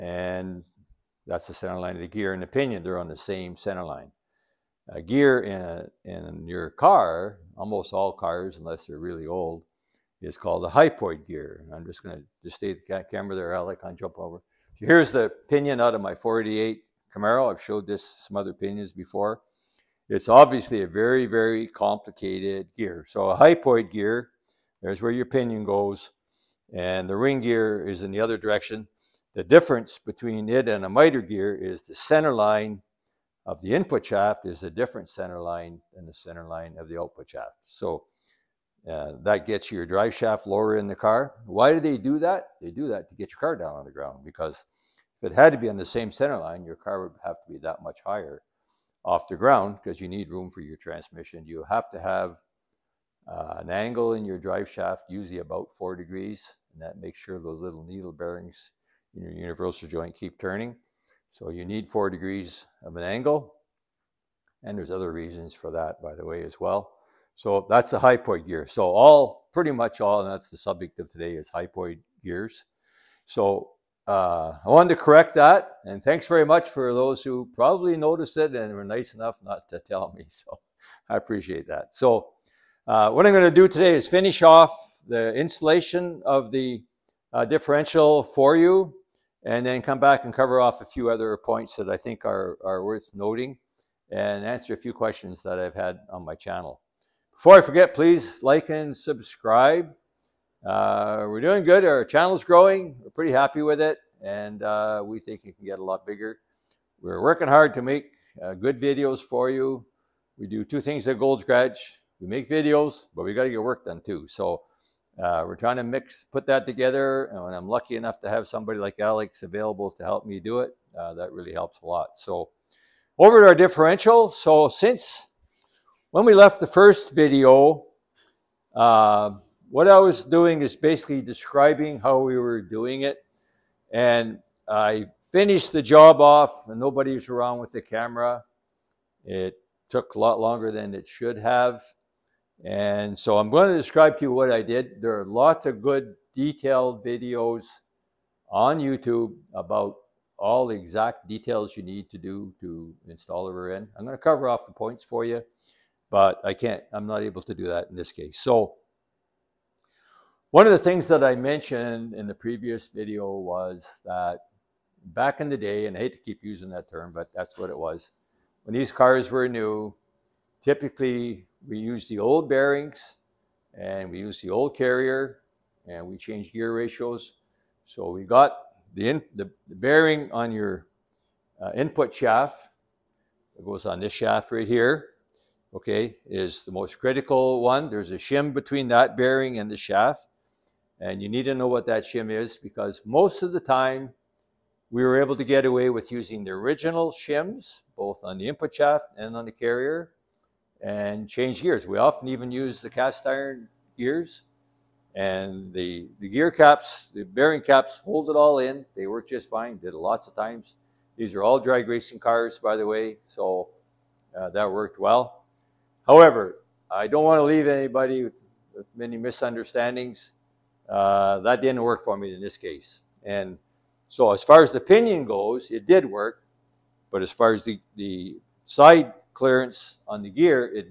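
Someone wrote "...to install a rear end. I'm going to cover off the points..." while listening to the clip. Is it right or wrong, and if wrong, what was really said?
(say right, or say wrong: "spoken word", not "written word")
right.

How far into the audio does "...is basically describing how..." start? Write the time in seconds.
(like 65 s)
130 s.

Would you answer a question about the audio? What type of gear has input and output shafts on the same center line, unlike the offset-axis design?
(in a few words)
Miter gear.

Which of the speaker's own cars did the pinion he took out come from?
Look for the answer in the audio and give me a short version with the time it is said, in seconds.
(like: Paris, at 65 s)
488 Camaro, at 16 s.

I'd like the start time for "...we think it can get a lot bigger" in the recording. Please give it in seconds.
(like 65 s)
105 s.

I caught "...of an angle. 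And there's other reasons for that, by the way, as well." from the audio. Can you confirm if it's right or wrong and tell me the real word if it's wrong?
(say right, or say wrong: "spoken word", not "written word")
right.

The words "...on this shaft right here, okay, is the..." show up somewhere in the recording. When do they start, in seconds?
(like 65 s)
183 s.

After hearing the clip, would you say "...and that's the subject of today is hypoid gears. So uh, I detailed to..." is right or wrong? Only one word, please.
wrong.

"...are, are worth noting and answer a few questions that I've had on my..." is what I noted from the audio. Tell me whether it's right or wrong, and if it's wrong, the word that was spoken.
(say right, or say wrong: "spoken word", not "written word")
right.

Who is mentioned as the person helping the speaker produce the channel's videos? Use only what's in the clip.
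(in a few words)
Alex.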